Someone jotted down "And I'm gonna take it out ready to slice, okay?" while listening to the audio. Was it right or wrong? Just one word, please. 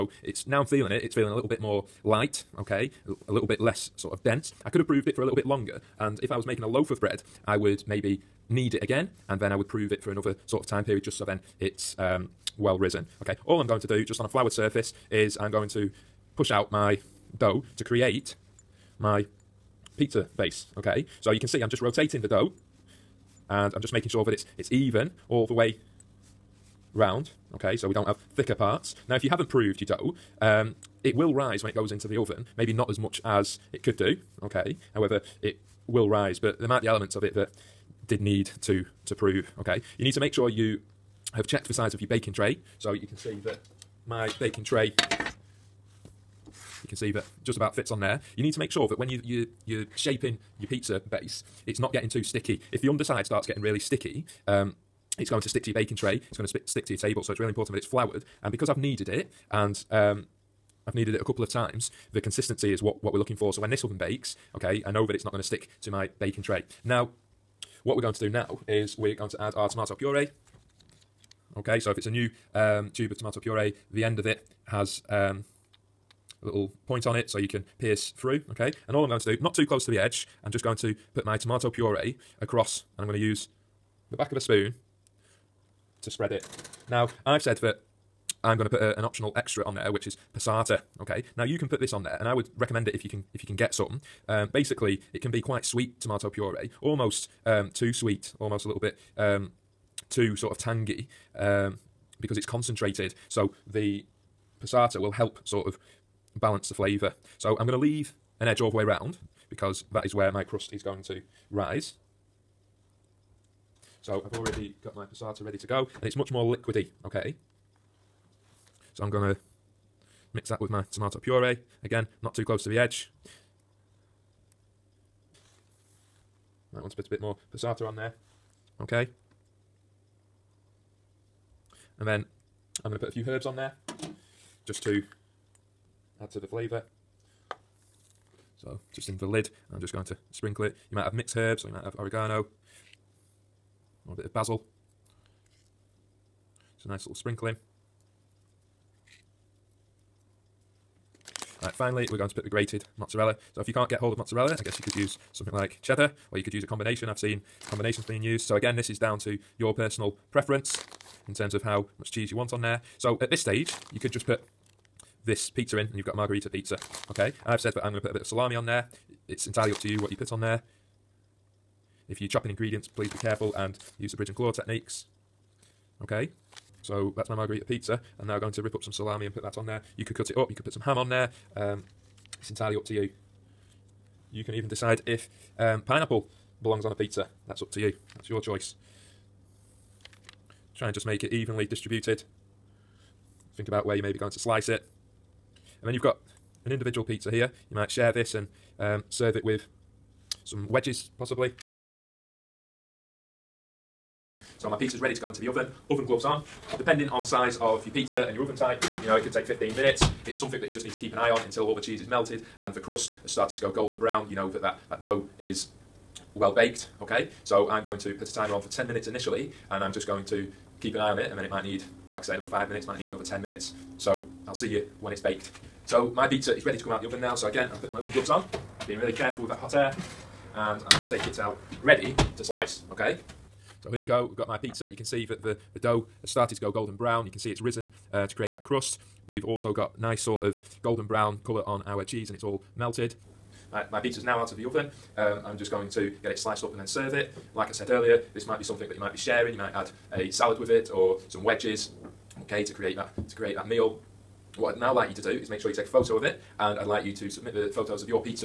right.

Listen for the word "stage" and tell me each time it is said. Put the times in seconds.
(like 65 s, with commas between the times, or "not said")
163 s.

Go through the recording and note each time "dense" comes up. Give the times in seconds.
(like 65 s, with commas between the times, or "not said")
4 s.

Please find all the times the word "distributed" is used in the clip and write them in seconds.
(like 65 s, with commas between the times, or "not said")
191 s.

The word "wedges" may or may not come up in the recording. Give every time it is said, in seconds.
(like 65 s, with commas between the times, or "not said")
200 s, 251 s.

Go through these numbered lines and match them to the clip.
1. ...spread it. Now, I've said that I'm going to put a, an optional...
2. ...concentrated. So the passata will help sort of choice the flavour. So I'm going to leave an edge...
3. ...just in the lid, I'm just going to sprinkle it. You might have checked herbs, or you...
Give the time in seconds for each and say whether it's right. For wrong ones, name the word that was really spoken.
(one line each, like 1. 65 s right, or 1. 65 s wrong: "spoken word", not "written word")
1. 86 s right
2. 102 s wrong: "balance", not "choice"
3. 138 s wrong: "mixed", not "checked".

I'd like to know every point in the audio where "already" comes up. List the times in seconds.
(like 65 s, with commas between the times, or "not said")
114 s.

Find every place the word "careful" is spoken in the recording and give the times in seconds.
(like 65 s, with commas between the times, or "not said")
173 s, 229 s.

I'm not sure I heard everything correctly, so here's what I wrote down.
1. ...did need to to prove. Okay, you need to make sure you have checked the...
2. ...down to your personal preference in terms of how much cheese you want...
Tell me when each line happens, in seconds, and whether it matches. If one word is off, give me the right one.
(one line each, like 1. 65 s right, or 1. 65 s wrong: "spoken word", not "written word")
1. 38 s right
2. 158 s right.